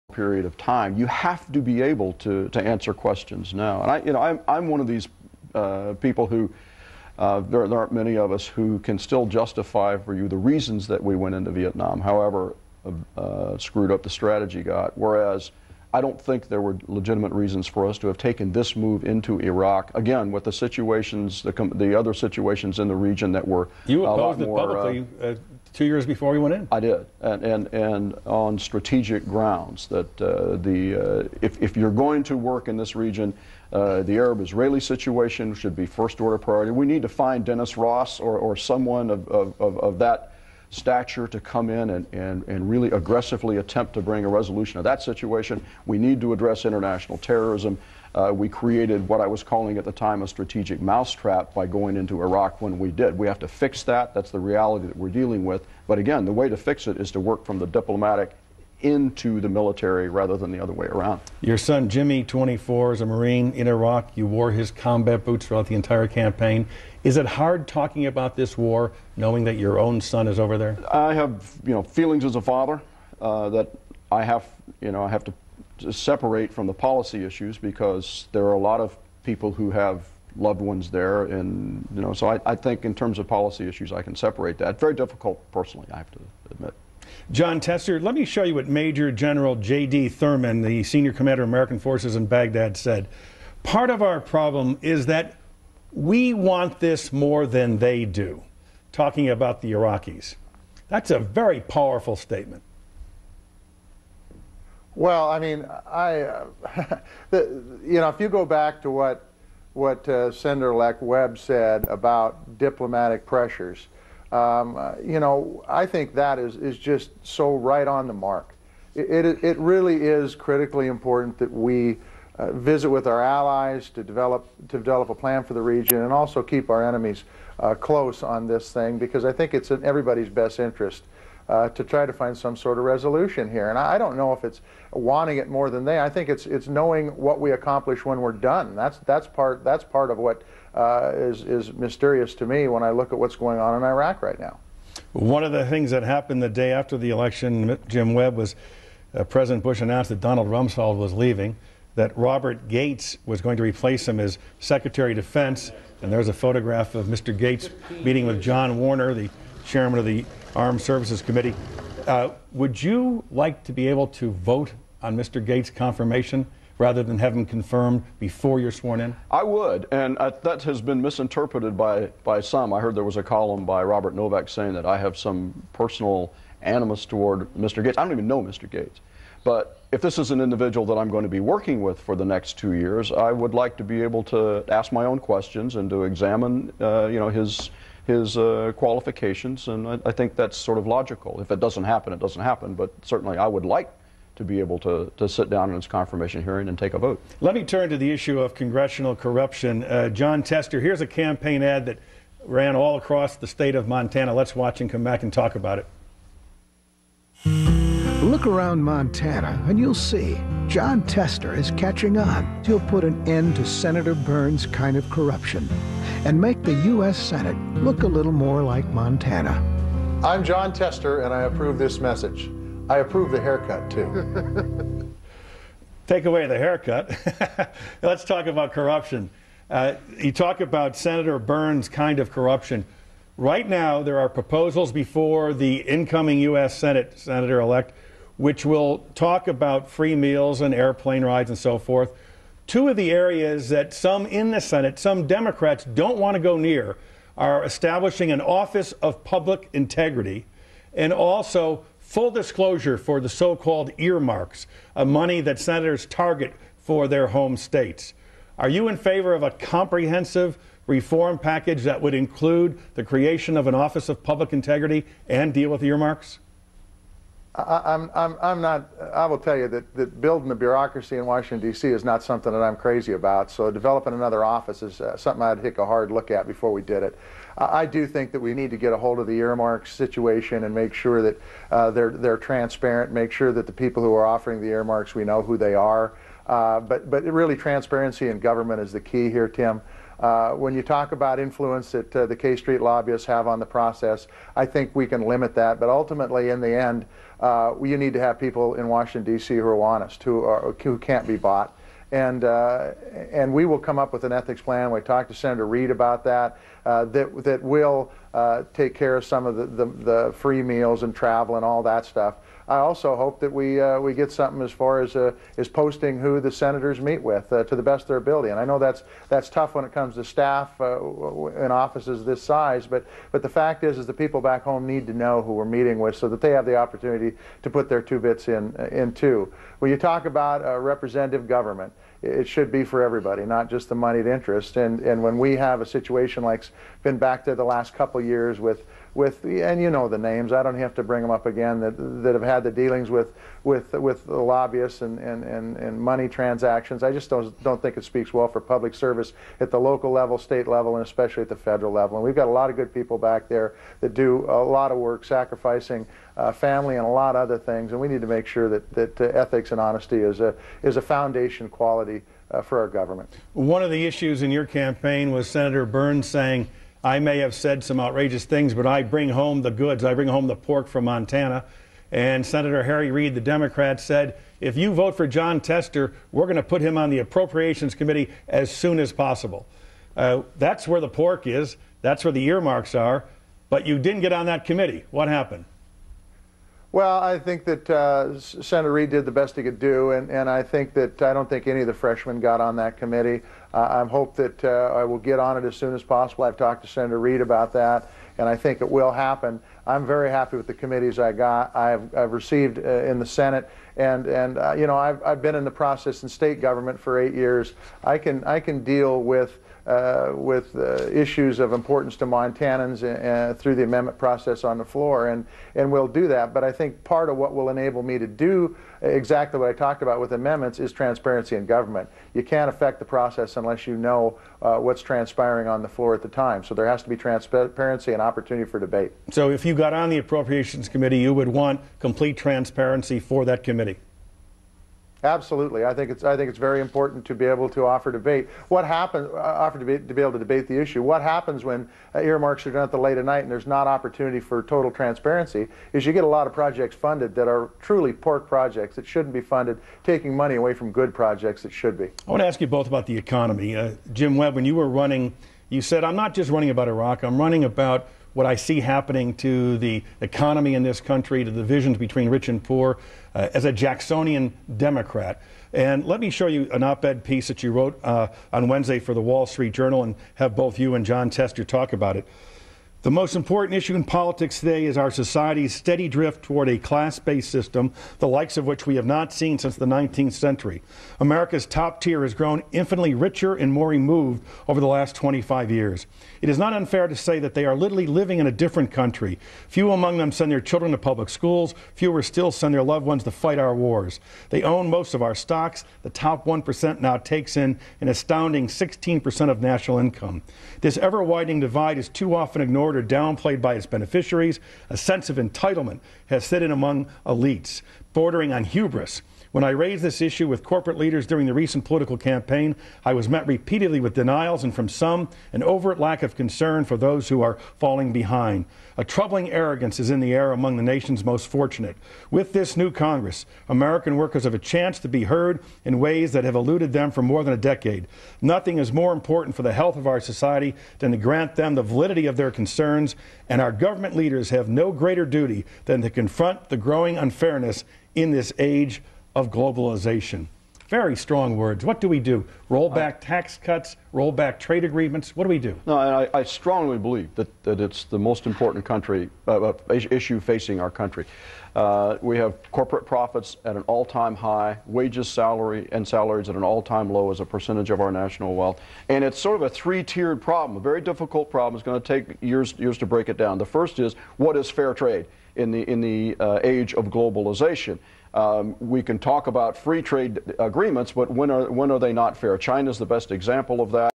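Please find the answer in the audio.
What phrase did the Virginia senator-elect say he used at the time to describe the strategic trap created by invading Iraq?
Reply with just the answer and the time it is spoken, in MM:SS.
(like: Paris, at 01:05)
strategic mousetrap, at 00:50.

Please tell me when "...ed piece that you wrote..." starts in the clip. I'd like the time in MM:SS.
07:47.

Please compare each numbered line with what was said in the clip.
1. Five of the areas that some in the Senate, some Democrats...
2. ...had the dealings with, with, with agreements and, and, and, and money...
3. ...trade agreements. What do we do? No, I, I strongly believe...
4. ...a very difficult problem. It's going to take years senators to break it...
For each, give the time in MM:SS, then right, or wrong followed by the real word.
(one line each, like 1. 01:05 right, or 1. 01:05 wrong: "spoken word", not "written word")
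1. 04:02 wrong: "Two", not "Five"
2. 05:42 wrong: "lobbyists", not "agreements"
3. 09:04 right
4. 09:20 wrong: "years", not "senators".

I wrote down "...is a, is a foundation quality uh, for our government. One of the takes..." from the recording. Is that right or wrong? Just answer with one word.
wrong.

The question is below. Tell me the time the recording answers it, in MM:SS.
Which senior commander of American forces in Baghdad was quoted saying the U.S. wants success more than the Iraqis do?
01:29.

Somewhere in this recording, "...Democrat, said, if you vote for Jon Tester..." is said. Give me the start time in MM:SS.
06:13.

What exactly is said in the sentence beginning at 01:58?
It it, it really is critically important that we.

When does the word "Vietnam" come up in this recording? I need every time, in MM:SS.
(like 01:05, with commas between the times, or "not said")
00:11.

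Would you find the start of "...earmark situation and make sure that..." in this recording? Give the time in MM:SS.
04:39.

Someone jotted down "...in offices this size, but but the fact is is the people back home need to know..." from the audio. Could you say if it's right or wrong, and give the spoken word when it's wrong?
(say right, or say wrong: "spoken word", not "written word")
right.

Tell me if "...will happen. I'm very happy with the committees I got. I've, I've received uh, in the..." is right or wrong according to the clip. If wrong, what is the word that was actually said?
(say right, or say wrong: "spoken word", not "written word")
right.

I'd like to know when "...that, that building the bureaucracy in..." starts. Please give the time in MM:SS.
04:29.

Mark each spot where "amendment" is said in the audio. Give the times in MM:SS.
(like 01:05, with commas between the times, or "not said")
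06:53, 07:00.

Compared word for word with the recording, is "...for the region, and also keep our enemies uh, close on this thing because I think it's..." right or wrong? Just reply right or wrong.
right.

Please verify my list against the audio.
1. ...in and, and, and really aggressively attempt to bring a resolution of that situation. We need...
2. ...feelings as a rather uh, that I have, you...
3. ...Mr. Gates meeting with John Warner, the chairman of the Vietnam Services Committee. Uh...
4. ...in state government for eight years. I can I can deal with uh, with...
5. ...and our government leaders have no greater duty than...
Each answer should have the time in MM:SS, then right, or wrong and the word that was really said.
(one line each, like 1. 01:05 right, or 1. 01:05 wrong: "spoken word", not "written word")
1. 00:41 right
2. 01:11 wrong: "father", not "rather"
3. 02:37 wrong: "Armed", not "Vietnam"
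4. 06:46 right
5. 08:53 right.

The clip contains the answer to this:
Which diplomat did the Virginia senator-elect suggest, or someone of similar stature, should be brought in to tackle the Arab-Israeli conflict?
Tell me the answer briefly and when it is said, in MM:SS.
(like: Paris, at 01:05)
Dennis Ross, at 00:37.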